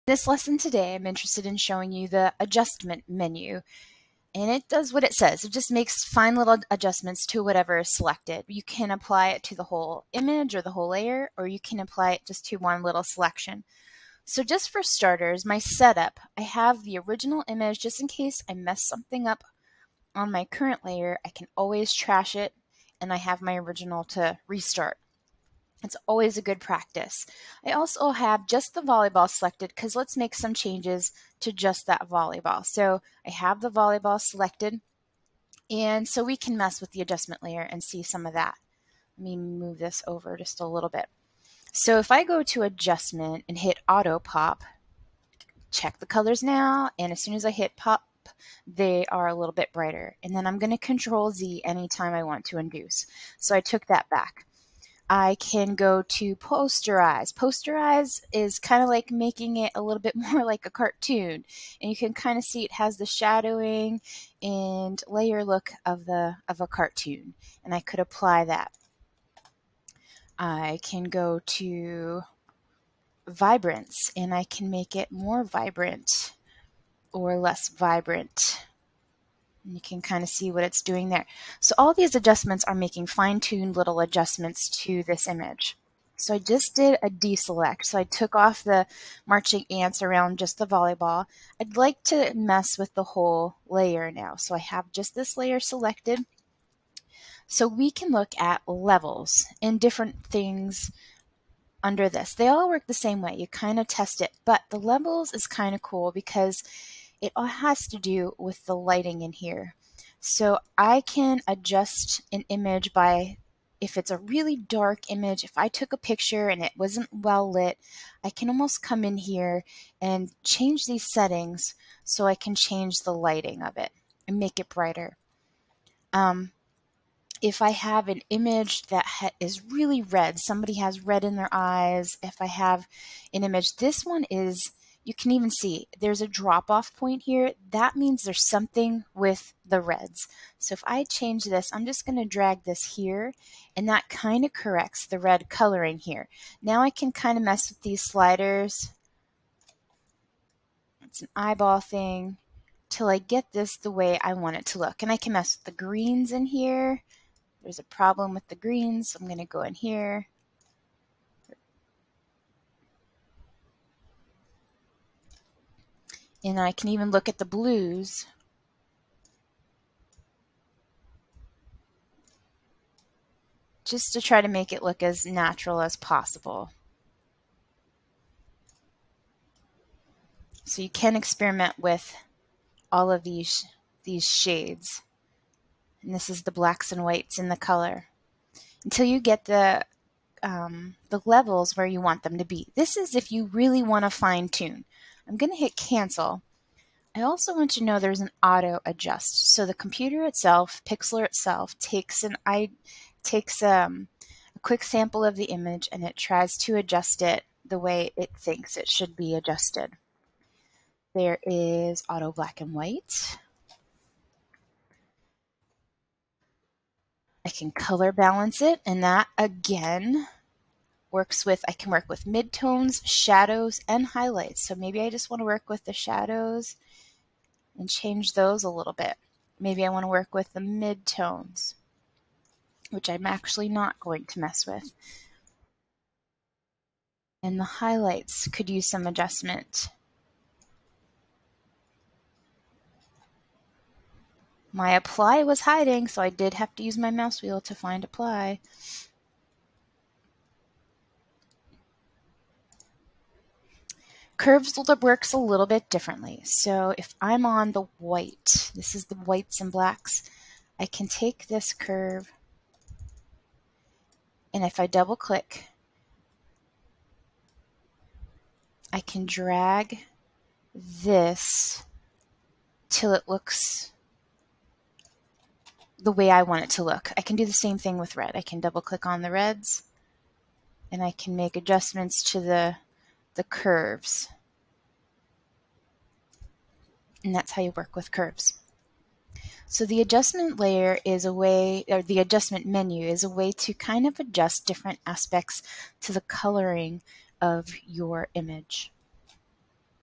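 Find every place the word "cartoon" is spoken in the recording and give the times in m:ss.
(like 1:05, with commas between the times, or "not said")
1:00, 1:06.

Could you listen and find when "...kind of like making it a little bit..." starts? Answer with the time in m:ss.
0:58.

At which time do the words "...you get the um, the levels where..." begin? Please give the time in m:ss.
3:09.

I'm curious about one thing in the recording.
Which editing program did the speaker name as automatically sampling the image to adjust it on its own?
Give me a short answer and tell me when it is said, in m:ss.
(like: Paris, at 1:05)
Pixlr, at 3:20.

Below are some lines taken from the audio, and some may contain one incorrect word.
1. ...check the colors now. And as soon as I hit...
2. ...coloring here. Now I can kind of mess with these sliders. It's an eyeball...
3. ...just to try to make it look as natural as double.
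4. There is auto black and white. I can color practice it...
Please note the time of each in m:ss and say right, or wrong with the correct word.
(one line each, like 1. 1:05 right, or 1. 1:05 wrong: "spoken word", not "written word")
1. 0:45 right
2. 2:25 right
3. 2:53 wrong: "possible", not "double"
4. 3:31 wrong: "balance", not "practice".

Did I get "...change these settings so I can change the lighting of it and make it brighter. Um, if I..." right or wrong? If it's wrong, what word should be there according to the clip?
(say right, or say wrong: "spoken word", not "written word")
right.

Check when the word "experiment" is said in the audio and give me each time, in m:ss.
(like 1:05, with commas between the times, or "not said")
3:01.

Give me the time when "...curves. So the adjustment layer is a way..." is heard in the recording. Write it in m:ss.
4:48.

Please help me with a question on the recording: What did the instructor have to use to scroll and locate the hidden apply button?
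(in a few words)
mouse wheel.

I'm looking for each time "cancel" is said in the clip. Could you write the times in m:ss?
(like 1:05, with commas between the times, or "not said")
3:15.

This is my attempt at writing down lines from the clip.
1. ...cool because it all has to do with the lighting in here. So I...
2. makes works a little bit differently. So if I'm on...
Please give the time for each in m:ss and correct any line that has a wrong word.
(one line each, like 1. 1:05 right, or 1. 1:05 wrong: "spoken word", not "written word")
1. 1:45 right
2. 4:14 wrong: "curves", not "makes".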